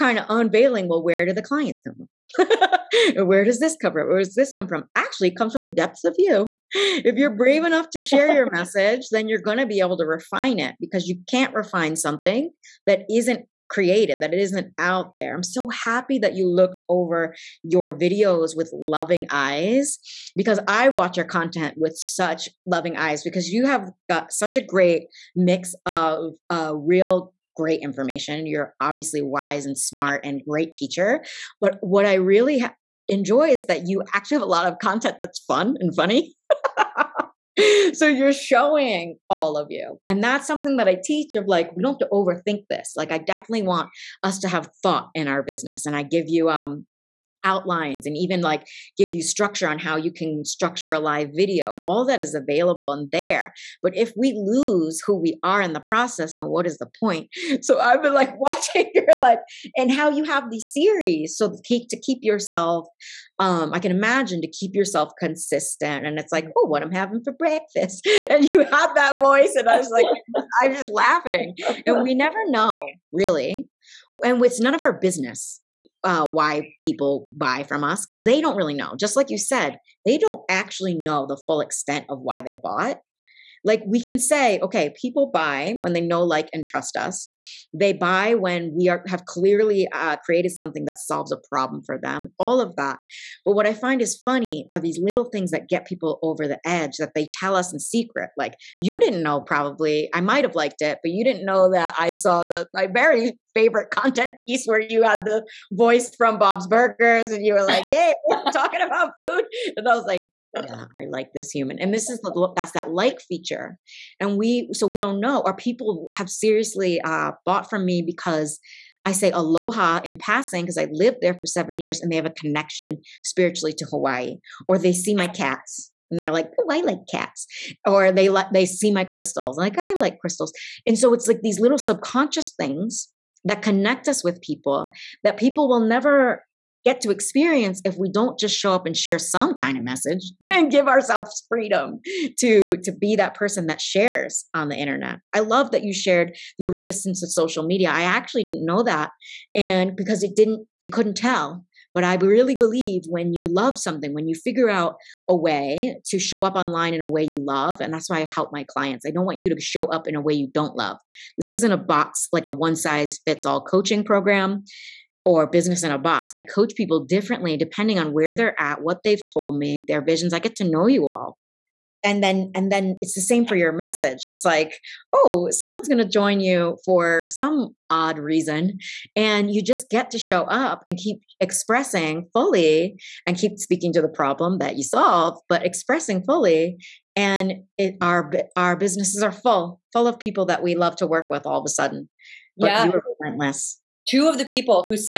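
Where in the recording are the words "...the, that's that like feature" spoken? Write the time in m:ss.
1:52.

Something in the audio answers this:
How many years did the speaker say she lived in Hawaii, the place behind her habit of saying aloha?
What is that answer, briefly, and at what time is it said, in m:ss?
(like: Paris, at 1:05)
7, at 2:01.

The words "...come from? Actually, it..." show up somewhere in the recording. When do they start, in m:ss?
0:04.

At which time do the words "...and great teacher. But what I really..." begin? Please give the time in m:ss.
0:30.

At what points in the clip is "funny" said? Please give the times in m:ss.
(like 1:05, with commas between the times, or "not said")
0:35, 1:34.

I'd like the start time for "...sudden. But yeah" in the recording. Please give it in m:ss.
3:11.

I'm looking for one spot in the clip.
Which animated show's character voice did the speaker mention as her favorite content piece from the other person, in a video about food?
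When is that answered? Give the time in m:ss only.
1:46.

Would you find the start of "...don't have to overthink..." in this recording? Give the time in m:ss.
0:41.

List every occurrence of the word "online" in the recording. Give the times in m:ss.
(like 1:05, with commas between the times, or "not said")
2:36.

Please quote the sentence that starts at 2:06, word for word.
And they're like, oh, I like cats.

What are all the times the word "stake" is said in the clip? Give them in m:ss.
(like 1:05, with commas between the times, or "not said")
not said.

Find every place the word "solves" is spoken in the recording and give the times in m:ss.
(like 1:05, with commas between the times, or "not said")
1:30, 3:04.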